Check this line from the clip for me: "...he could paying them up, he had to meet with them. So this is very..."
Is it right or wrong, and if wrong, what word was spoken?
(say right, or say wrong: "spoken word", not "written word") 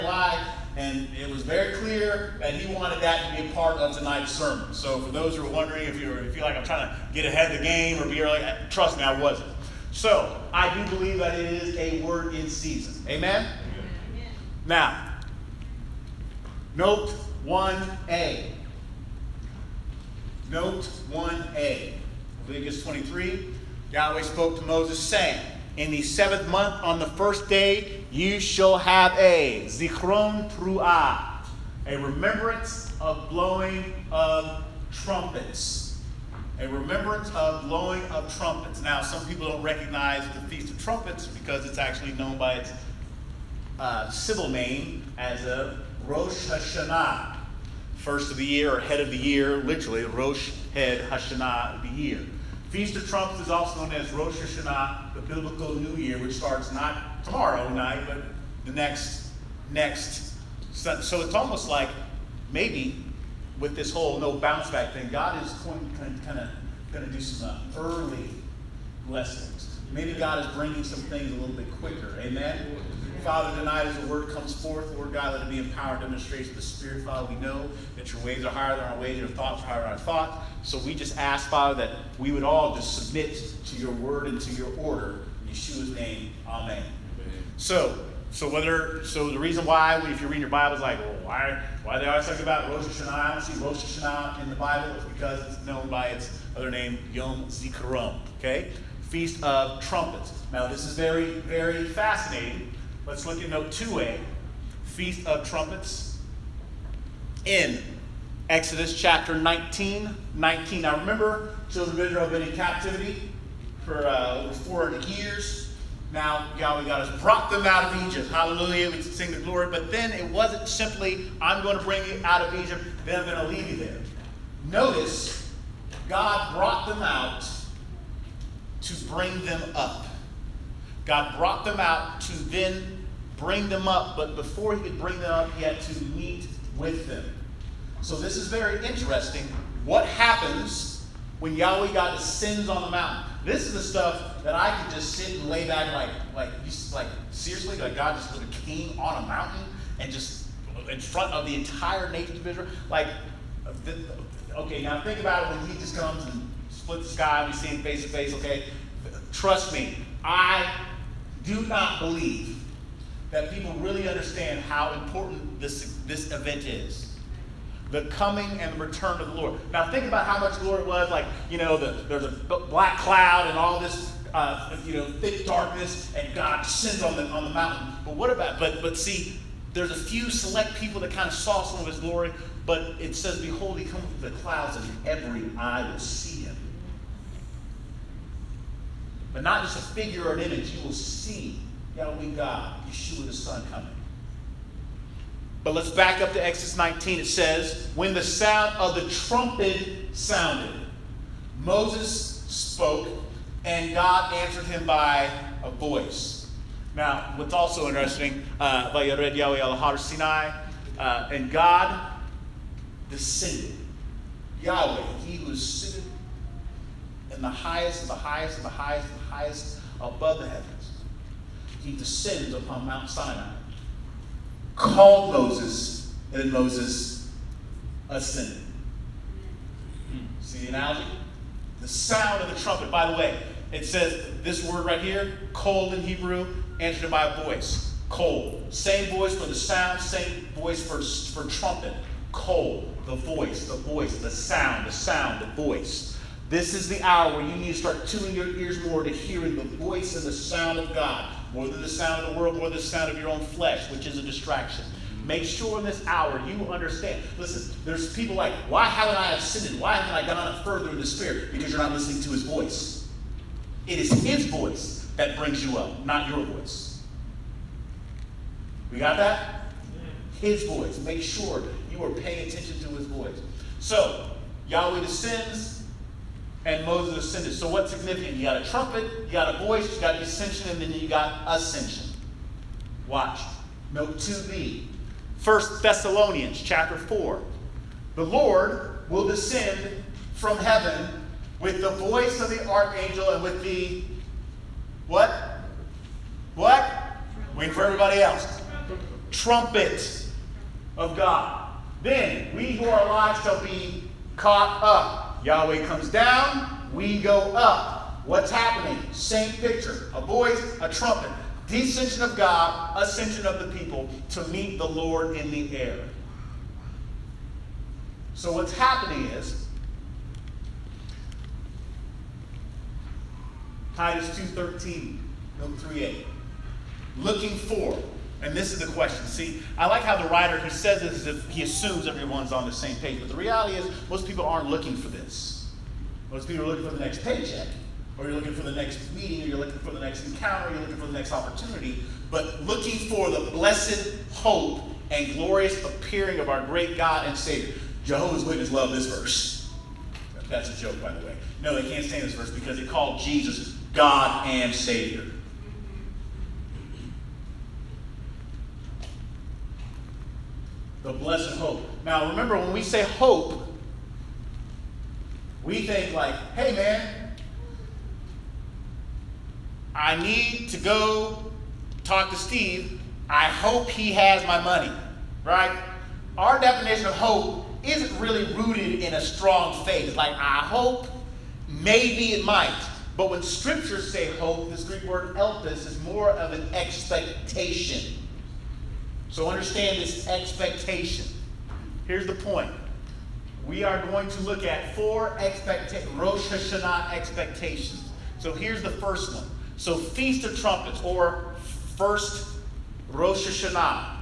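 wrong: "bring", not "paying".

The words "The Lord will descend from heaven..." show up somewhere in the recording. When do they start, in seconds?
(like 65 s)
288 s.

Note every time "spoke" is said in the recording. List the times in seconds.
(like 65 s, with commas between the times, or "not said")
24 s, 202 s.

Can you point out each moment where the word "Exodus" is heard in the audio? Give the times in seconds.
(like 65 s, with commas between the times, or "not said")
108 s, 196 s.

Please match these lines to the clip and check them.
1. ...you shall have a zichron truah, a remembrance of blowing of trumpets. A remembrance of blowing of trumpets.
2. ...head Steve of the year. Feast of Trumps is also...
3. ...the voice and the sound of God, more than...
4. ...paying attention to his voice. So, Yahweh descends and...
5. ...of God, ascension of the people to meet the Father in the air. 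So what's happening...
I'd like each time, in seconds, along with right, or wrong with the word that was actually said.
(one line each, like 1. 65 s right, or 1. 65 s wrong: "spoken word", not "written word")
1. 28 s right
2. 50 s wrong: "Hashanah", not "Steve"
3. 249 s right
4. 272 s right
5. 312 s wrong: "Lord", not "Father".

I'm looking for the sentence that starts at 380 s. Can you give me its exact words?
like, I hope, maybe it might.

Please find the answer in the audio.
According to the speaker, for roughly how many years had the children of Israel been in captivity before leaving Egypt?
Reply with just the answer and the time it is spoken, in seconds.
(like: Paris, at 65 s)
over 400 years, at 114 s.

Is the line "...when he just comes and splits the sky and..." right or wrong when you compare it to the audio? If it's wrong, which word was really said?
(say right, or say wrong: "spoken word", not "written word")
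right.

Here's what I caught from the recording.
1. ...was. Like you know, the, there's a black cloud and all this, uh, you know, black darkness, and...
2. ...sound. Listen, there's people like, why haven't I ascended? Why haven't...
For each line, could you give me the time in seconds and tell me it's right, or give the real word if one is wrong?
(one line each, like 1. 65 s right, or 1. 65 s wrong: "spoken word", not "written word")
1. 170 s wrong: "thick", not "black"
2. 256 s wrong: "understand", not "sound".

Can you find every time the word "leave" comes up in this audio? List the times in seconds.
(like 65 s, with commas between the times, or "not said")
123 s.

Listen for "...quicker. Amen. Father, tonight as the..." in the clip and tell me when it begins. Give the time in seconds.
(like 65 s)
71 s.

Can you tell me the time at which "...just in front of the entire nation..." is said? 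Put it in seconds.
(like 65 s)
150 s.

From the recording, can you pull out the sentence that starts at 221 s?
He descends upon Mount Sinai, called Moses, and Moses ascended.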